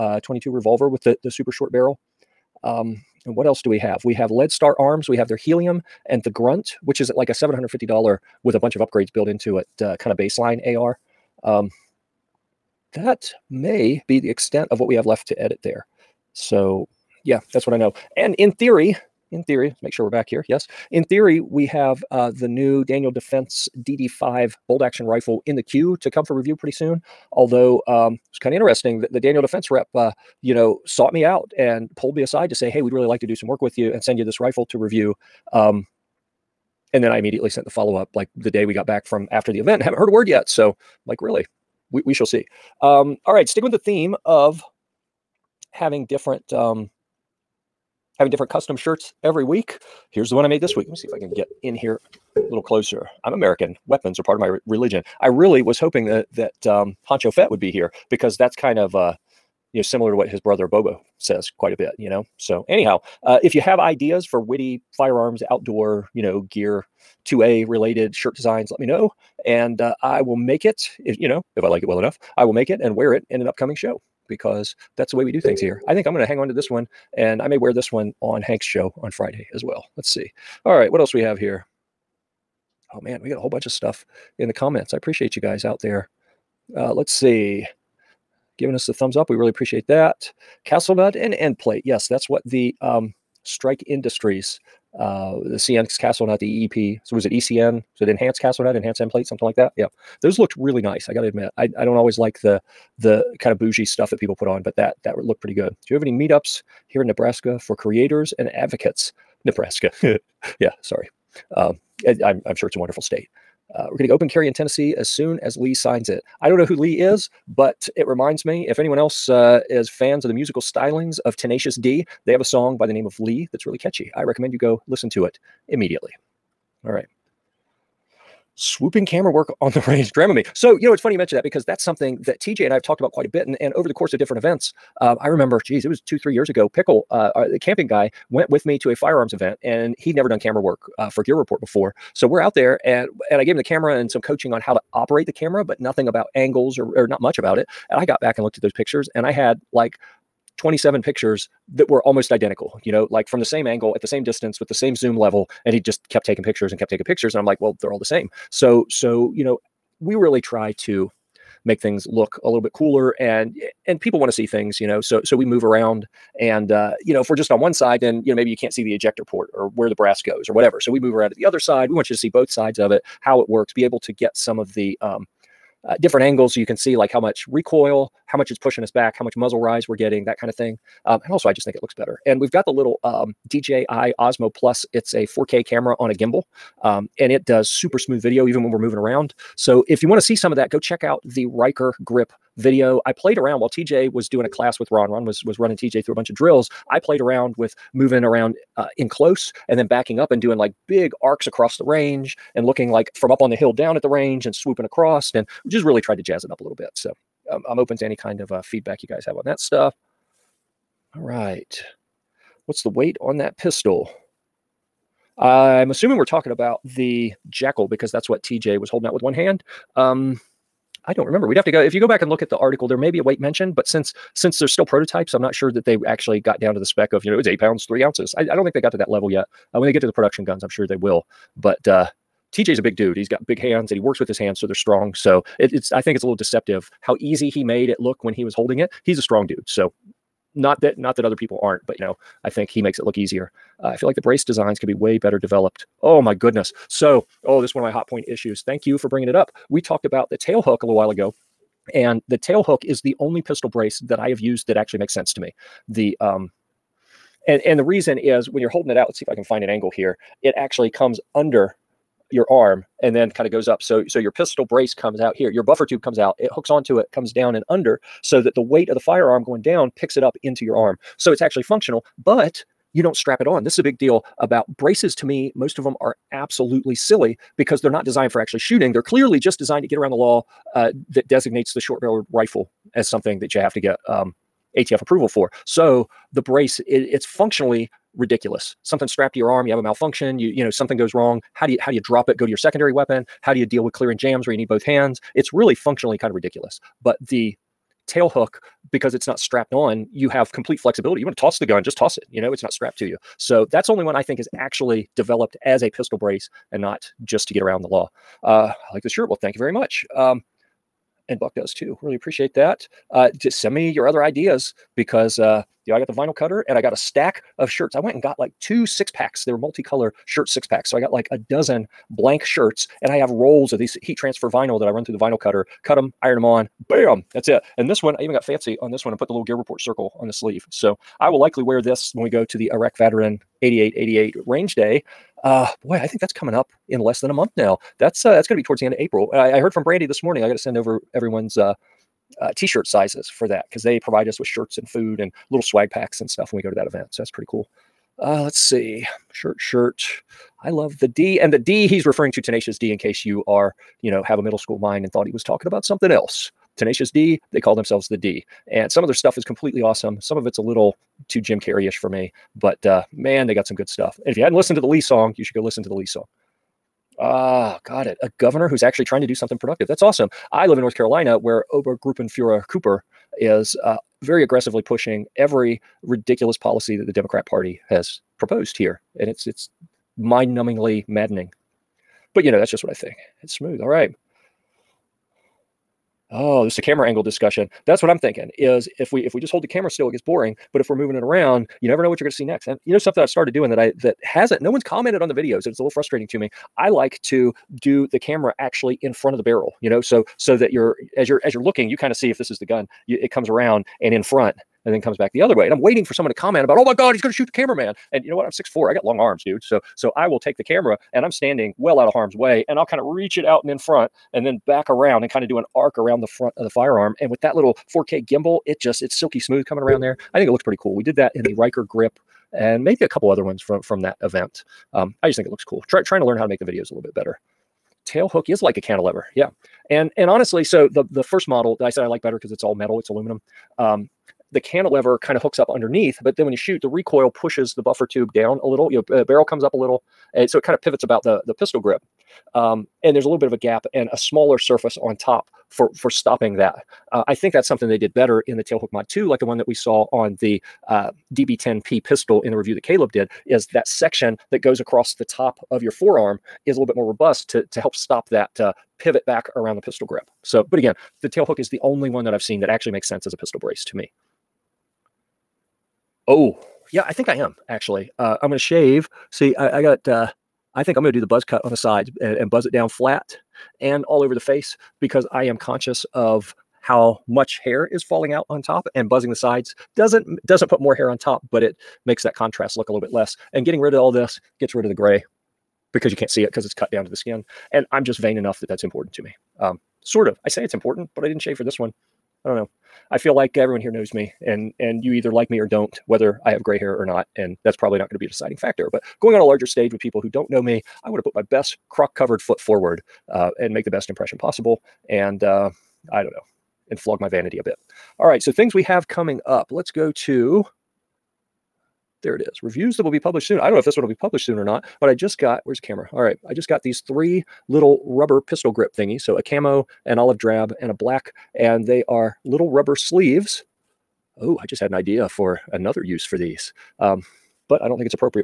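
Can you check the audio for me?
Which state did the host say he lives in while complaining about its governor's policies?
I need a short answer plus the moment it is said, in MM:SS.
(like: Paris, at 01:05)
North Carolina, at 06:10.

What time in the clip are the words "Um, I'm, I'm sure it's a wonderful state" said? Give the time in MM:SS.
01:51.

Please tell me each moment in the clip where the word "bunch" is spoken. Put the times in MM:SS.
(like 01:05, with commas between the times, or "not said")
00:08, 01:23, 03:16.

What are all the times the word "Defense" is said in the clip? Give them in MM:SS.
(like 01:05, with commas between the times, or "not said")
00:23, 00:29.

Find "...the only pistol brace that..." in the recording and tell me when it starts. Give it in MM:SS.
04:13.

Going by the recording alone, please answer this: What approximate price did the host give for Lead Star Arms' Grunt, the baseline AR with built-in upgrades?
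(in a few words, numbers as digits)
$750.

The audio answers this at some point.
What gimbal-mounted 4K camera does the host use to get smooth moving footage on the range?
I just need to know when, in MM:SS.
03:03.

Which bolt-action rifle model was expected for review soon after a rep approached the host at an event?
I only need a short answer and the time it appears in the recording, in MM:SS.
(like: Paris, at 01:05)
DD5, at 00:23.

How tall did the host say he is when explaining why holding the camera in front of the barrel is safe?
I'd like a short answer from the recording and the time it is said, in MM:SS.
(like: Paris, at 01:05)
6'4", at 06:48.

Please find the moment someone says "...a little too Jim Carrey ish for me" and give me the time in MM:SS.
06:00.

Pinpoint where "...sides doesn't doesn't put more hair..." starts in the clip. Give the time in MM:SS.
07:59.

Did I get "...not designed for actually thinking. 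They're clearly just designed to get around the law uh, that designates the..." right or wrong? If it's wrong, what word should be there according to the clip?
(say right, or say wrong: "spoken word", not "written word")
wrong: "shooting", not "thinking".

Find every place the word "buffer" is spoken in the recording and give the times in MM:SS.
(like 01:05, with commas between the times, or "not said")
04:25, 07:17.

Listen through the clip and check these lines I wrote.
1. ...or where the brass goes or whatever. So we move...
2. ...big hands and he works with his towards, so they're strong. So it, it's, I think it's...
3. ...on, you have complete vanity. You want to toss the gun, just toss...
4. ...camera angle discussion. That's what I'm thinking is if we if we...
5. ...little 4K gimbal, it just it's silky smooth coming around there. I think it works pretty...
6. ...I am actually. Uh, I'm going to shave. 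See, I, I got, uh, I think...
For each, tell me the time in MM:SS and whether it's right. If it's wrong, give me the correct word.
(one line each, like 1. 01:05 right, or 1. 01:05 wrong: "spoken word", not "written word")
1. 02:49 right
2. 03:53 wrong: "hands", not "towards"
3. 04:59 wrong: "flexibility", not "vanity"
4. 06:26 right
5. 06:57 wrong: "looks", not "works"
6. 07:47 right.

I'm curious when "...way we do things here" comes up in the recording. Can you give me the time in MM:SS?
01:15.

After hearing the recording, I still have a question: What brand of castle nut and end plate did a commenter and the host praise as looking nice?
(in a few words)
Strike Industries.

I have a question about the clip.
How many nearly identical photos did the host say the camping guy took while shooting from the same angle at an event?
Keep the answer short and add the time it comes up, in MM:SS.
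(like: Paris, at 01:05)
27, at 02:30.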